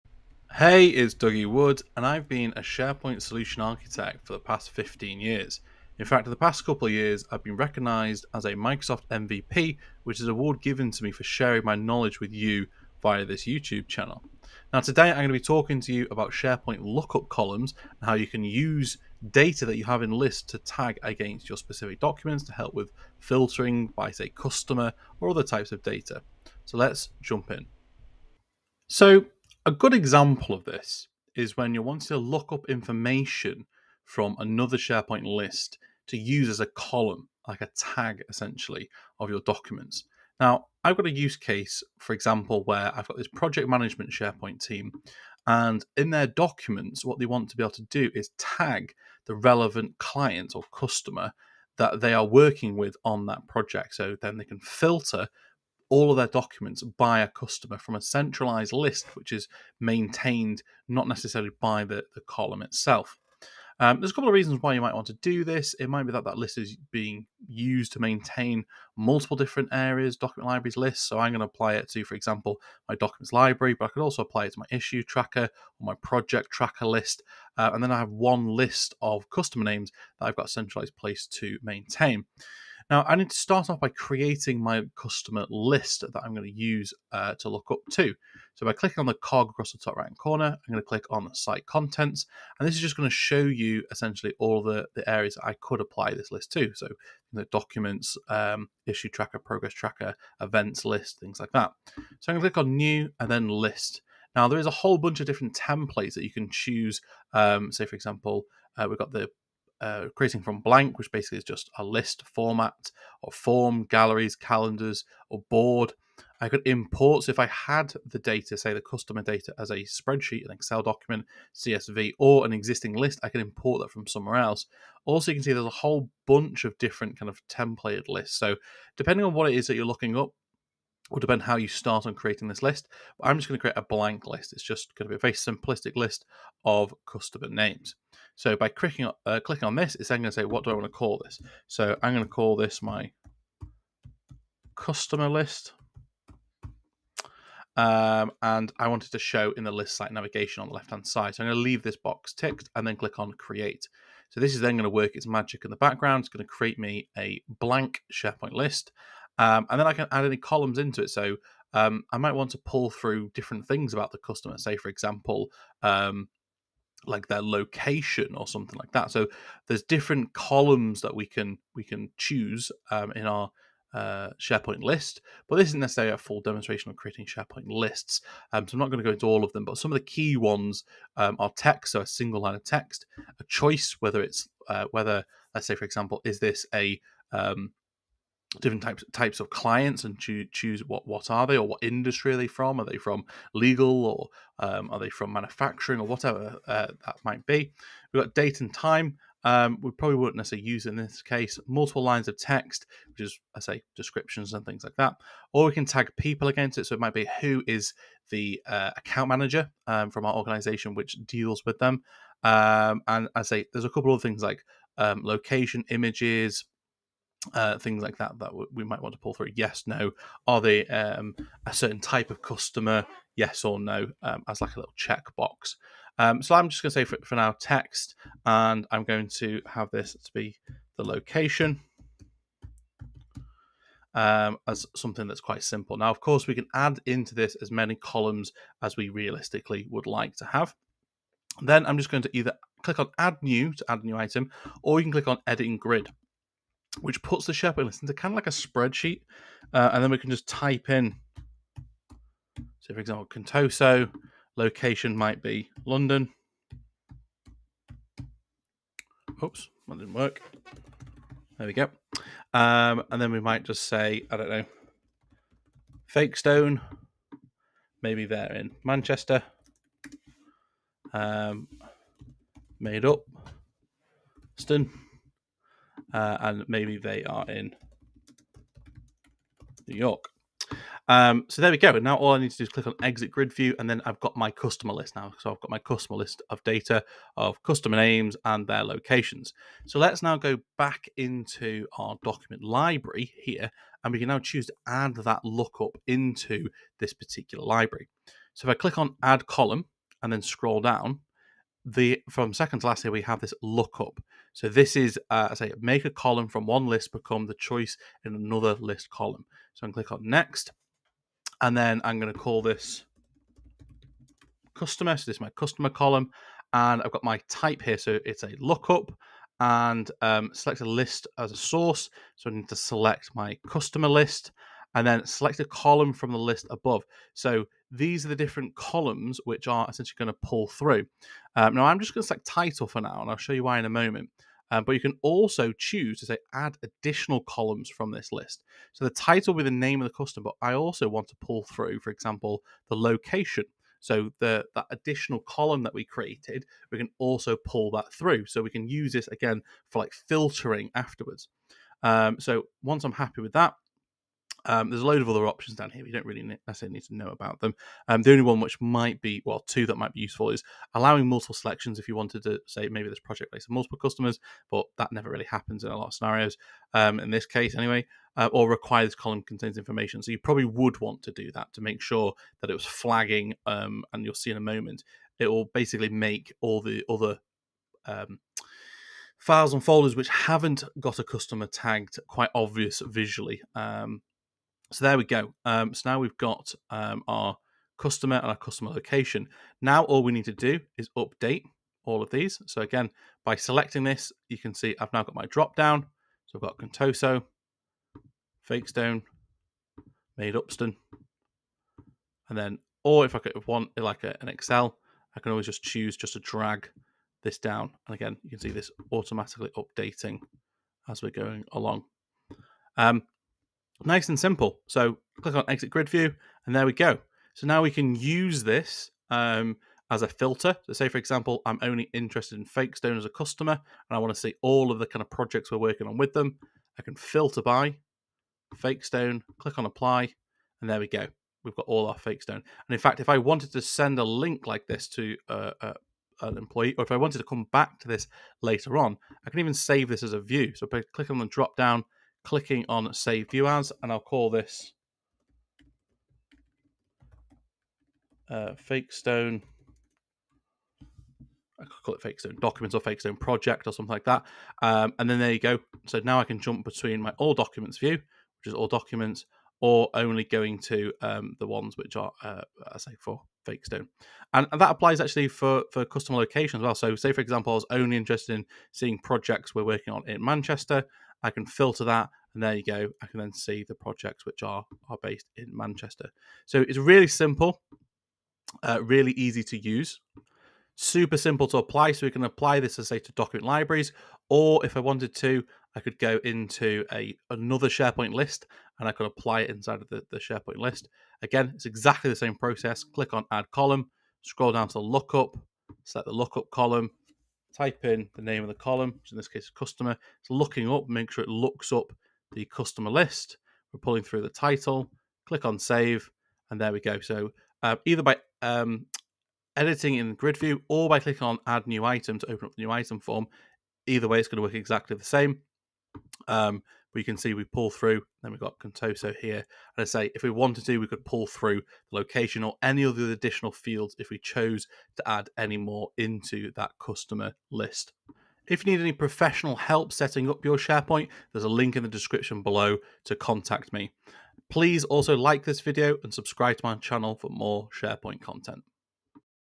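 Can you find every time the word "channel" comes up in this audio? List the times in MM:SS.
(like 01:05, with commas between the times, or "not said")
00:13, 08:56.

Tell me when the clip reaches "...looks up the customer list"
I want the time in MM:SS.
08:21.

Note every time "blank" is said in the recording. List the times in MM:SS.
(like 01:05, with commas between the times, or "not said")
01:50, 02:13, 02:37.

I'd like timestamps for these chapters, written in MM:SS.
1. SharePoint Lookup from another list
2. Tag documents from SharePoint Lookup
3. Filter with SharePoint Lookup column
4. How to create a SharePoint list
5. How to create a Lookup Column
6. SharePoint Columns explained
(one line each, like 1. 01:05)
1. 00:30
2. 06:35
3. 06:59
4. 01:50
5. 05:00
6. 03:03.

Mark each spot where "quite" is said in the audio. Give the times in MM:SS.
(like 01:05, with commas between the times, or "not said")
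03:55, 06:22.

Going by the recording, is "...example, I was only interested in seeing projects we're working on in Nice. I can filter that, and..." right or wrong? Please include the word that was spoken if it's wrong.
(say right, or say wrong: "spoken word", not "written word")
wrong: "Manchester", not "Nice".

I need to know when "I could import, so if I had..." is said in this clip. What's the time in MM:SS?
01:56.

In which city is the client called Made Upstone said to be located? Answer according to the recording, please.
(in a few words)
New York.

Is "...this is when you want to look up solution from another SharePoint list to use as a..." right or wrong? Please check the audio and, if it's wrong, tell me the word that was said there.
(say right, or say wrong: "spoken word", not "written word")
wrong: "information", not "solution".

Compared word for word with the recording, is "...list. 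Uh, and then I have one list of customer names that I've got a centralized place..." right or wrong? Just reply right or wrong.
right.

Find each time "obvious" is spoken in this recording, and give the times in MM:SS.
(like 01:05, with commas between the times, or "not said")
06:22.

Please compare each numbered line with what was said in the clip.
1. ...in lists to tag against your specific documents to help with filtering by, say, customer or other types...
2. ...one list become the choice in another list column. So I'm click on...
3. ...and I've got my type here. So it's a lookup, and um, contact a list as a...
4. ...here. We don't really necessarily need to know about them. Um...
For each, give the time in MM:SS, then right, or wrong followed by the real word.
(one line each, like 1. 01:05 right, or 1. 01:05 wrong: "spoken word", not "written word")
1. 00:20 right
2. 05:06 right
3. 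05:16 wrong: "select", not "contact"
4. 05:55 right.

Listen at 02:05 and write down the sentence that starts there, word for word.
Also, you can see there's a whole bunch of different kind of templated lists.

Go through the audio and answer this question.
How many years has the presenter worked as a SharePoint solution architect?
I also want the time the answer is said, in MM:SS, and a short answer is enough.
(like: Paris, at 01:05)
15, at 00:04.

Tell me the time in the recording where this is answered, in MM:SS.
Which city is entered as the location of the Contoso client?
04:15.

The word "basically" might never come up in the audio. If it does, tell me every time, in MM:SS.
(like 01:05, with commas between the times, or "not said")
01:51, 06:15.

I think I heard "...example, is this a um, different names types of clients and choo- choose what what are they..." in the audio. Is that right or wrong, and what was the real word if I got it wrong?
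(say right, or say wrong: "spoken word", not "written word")
wrong: "types", not "names".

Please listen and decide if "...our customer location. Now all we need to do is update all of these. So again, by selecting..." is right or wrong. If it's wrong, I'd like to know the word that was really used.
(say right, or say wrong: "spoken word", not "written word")
right.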